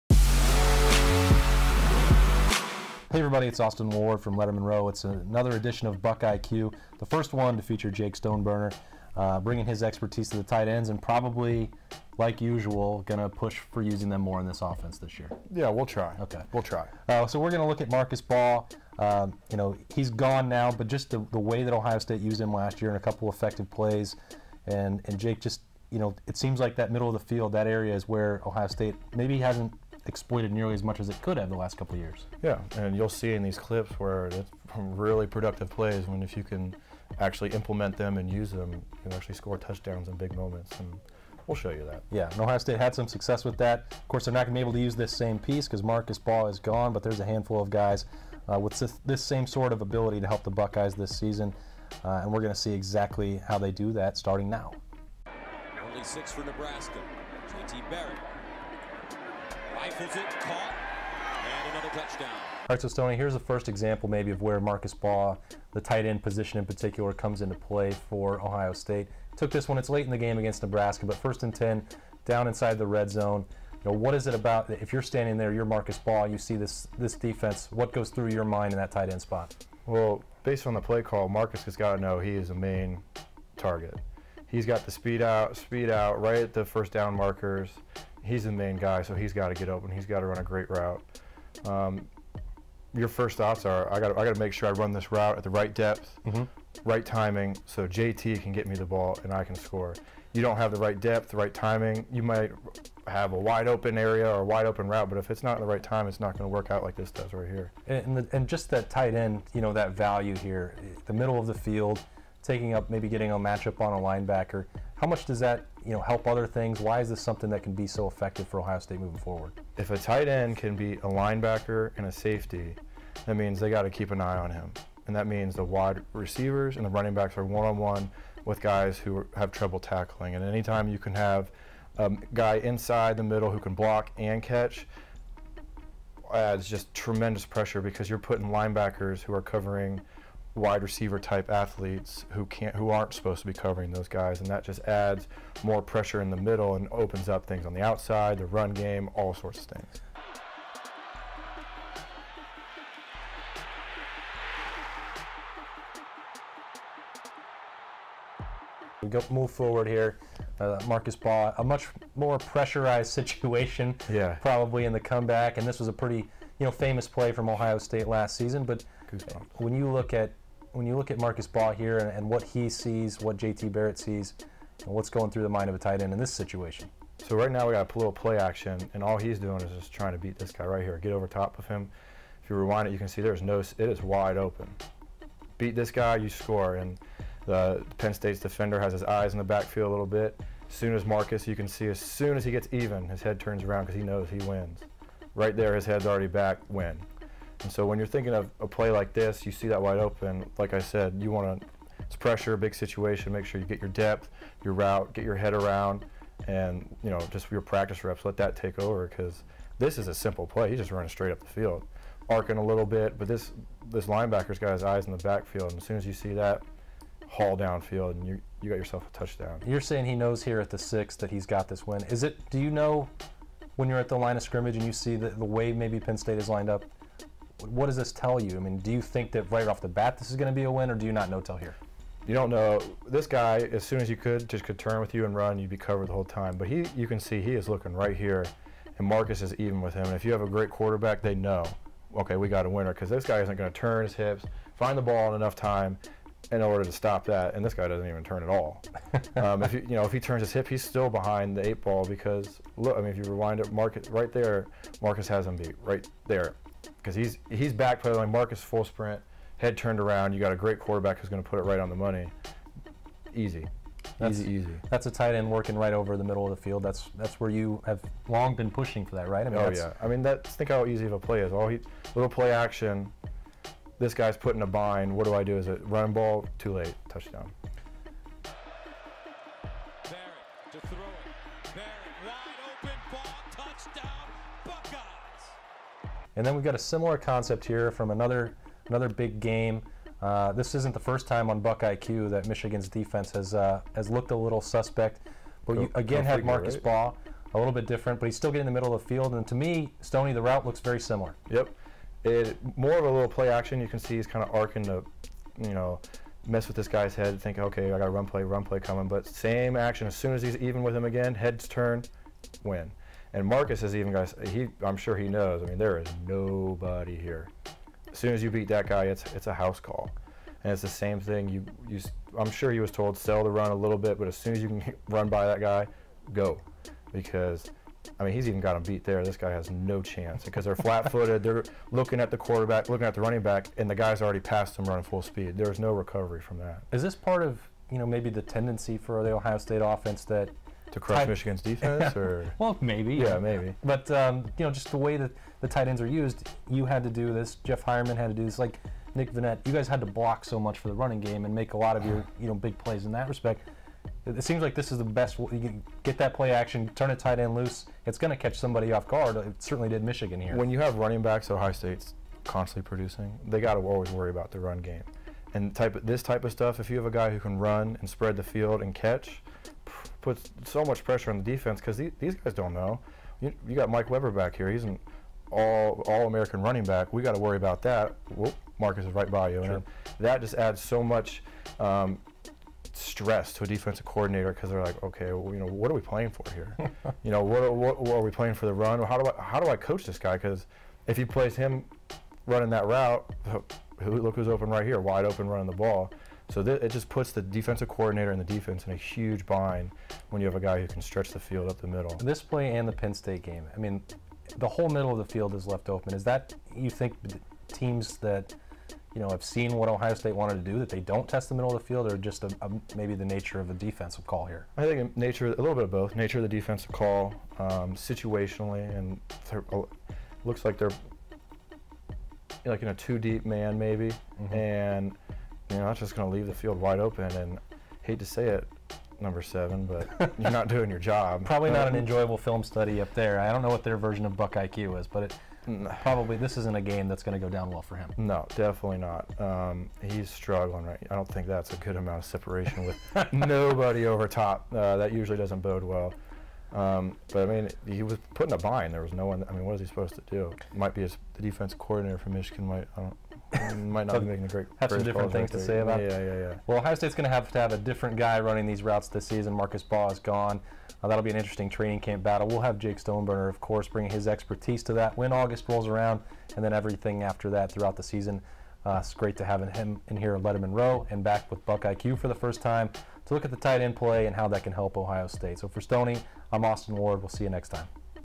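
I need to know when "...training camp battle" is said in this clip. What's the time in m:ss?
7:41.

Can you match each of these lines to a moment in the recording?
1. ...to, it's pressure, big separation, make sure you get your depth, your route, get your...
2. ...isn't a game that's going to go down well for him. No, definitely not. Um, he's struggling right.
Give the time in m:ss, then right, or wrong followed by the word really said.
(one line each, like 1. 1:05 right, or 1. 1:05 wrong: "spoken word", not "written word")
1. 3:21 wrong: "situation", not "separation"
2. 7:16 right.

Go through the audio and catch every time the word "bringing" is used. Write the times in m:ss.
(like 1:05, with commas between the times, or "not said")
0:09, 7:43.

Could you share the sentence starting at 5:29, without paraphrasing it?
This guy has no chance because they're flat footed.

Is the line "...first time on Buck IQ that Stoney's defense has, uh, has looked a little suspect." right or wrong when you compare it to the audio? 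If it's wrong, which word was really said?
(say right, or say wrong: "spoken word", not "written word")
wrong: "Michigan", not "Stoney".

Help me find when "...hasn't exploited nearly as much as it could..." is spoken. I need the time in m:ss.
0:29.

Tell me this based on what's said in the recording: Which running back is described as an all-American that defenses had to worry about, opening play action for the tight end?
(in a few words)
Mike Weber.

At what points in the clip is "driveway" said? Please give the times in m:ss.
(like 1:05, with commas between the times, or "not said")
not said.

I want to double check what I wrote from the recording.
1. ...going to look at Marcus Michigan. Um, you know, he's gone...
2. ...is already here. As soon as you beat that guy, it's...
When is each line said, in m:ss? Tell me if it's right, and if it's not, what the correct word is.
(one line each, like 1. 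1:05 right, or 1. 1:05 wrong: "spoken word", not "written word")
1. 0:17 wrong: "Baugh", not "Michigan"
2. 5:15 wrong: "nobody", not "already".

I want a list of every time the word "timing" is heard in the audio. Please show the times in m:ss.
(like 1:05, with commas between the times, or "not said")
1:37, 1:41.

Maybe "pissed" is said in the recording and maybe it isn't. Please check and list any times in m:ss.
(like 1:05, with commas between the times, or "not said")
not said.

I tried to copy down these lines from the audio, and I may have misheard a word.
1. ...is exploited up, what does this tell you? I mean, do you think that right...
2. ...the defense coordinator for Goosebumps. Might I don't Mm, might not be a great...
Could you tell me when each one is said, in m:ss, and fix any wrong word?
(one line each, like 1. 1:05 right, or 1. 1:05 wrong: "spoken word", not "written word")
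1. 3:46 wrong: "lined", not "exploited"
2. 7:31 wrong: "Michigan", not "Goosebumps".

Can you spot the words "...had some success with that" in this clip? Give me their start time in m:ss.
0:42.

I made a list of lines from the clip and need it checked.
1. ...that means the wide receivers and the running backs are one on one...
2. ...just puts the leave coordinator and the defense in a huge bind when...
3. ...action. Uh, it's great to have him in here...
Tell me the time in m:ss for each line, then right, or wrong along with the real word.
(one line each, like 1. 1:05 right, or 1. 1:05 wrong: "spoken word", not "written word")
1. 2:05 right
2. 6:36 wrong: "defensive", not "leave"
3. 7:48 wrong: "season", not "action".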